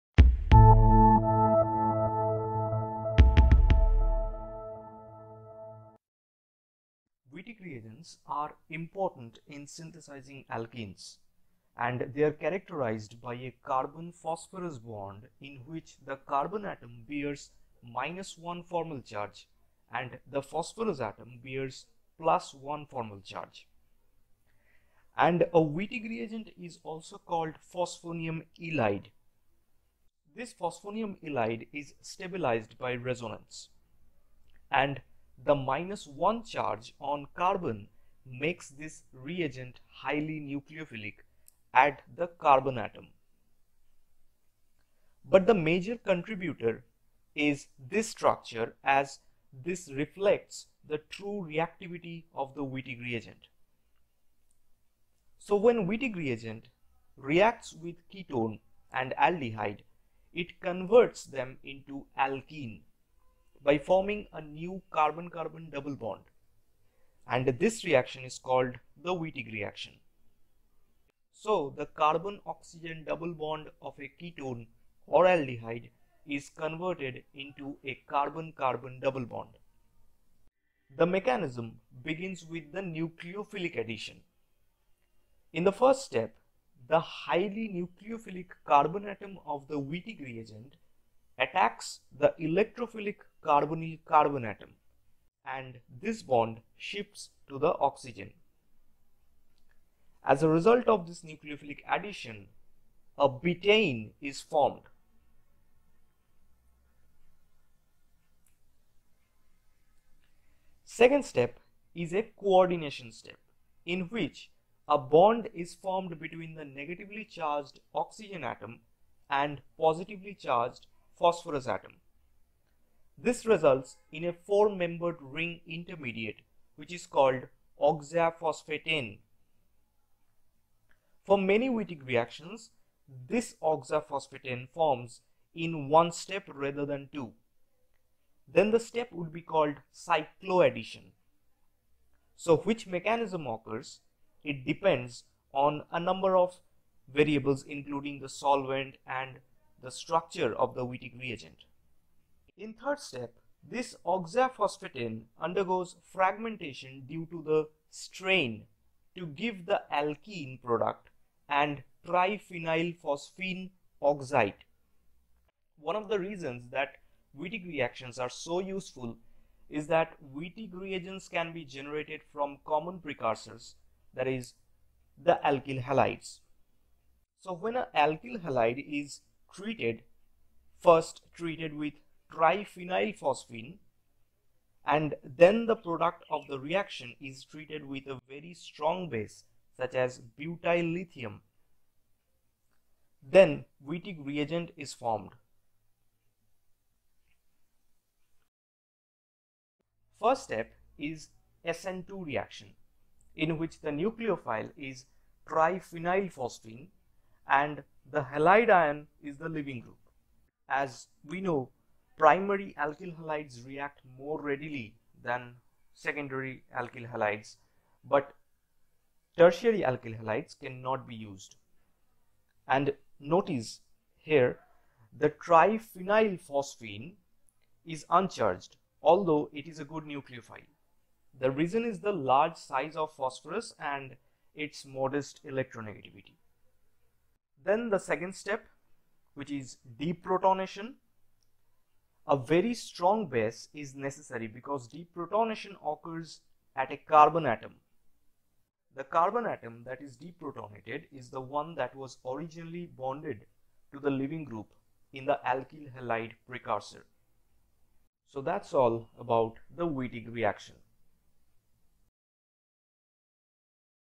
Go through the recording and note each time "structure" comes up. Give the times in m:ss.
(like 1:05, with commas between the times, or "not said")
0:48, 2:29.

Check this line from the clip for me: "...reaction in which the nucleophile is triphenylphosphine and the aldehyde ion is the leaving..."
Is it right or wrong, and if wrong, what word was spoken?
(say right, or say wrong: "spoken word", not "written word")
wrong: "halide", not "aldehyde".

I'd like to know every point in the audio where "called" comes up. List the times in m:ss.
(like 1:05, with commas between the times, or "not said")
0:27, 1:08, 2:07, 2:19.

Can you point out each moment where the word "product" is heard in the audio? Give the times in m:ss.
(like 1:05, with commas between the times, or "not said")
2:40, 3:05.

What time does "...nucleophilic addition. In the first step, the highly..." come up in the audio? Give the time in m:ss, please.
1:22.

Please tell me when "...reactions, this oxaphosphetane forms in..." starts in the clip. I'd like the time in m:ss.
2:12.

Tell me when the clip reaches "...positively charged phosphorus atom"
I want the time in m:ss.
1:59.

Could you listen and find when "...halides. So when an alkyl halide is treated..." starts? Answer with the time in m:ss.
2:55.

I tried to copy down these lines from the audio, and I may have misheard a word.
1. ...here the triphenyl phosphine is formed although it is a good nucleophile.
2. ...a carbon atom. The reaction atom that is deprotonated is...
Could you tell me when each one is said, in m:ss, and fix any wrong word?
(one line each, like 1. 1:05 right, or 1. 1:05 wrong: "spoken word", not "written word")
1. 3:44 wrong: "uncharged", not "formed"
2. 4:06 wrong: "carbon", not "reaction".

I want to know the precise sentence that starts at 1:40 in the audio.
As a result of this nucleophilic addition, a betaine is formed.